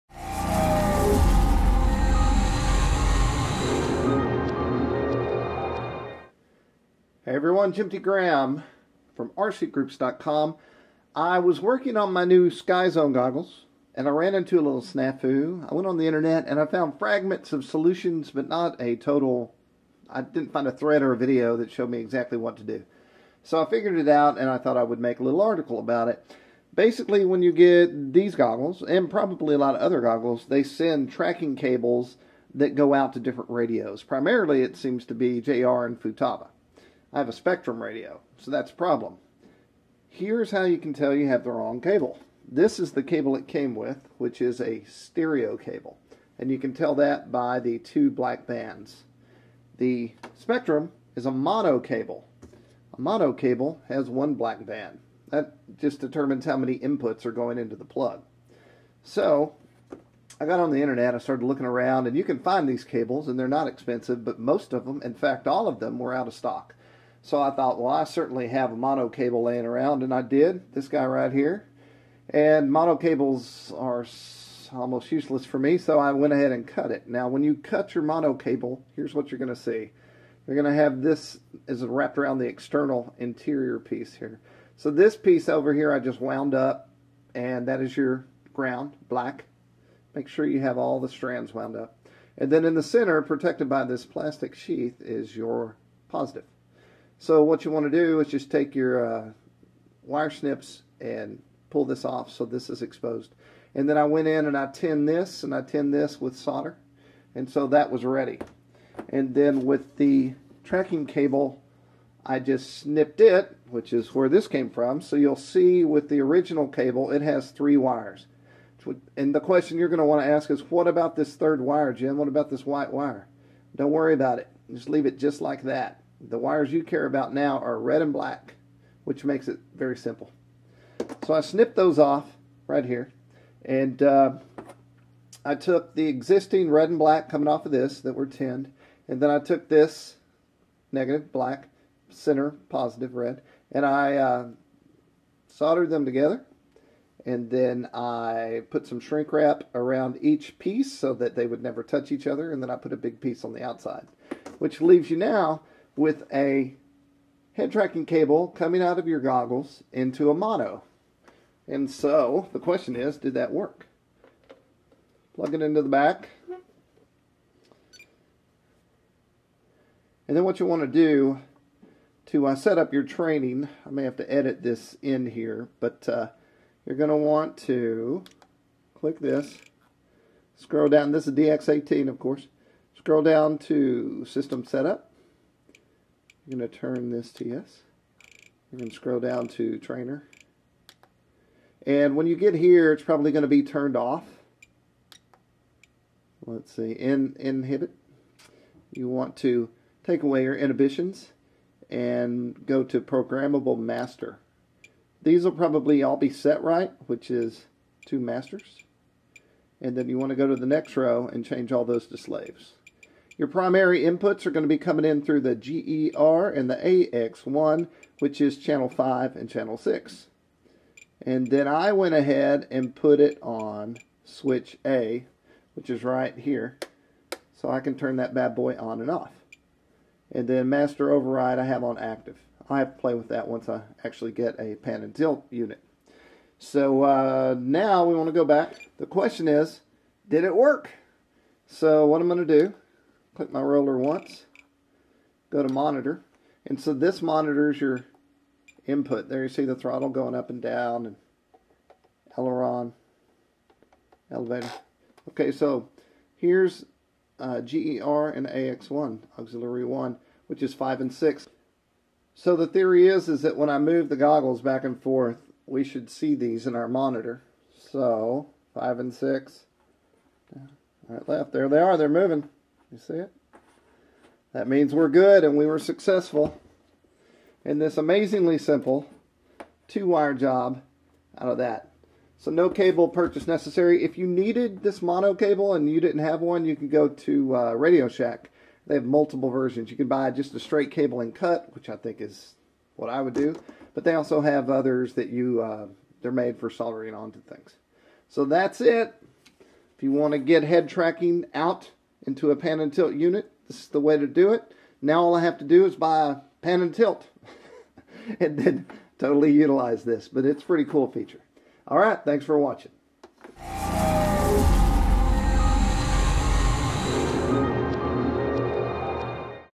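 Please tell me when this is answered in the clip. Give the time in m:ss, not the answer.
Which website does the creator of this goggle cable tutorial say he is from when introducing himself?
0:09.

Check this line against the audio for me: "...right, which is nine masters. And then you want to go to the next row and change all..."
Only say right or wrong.
wrong.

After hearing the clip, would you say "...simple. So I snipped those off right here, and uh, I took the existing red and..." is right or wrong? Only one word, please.
right.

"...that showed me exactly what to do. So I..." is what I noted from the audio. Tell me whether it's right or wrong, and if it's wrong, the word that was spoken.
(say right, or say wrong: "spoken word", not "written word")
right.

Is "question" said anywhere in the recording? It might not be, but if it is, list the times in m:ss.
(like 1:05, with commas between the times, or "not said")
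1:59, 2:42, 3:59.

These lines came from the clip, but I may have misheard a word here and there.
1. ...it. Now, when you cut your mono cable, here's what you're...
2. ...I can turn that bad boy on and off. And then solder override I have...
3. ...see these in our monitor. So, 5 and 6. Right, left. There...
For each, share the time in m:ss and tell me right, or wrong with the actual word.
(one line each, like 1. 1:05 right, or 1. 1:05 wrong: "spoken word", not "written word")
1. 1:16 right
2. 3:47 wrong: "master", not "solder"
3. 4:26 right.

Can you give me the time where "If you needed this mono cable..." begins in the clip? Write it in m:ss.
4:44.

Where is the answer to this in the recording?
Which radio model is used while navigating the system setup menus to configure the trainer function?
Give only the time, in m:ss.
3:01.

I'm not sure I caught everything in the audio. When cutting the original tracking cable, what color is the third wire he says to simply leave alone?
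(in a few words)
white.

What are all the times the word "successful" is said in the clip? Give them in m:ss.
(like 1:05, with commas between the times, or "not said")
4:35.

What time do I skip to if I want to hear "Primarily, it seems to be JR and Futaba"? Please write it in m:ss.
0:34.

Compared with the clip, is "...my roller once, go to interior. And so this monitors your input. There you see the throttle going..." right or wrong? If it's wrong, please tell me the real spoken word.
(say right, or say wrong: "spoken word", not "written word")
wrong: "monitor", not "interior".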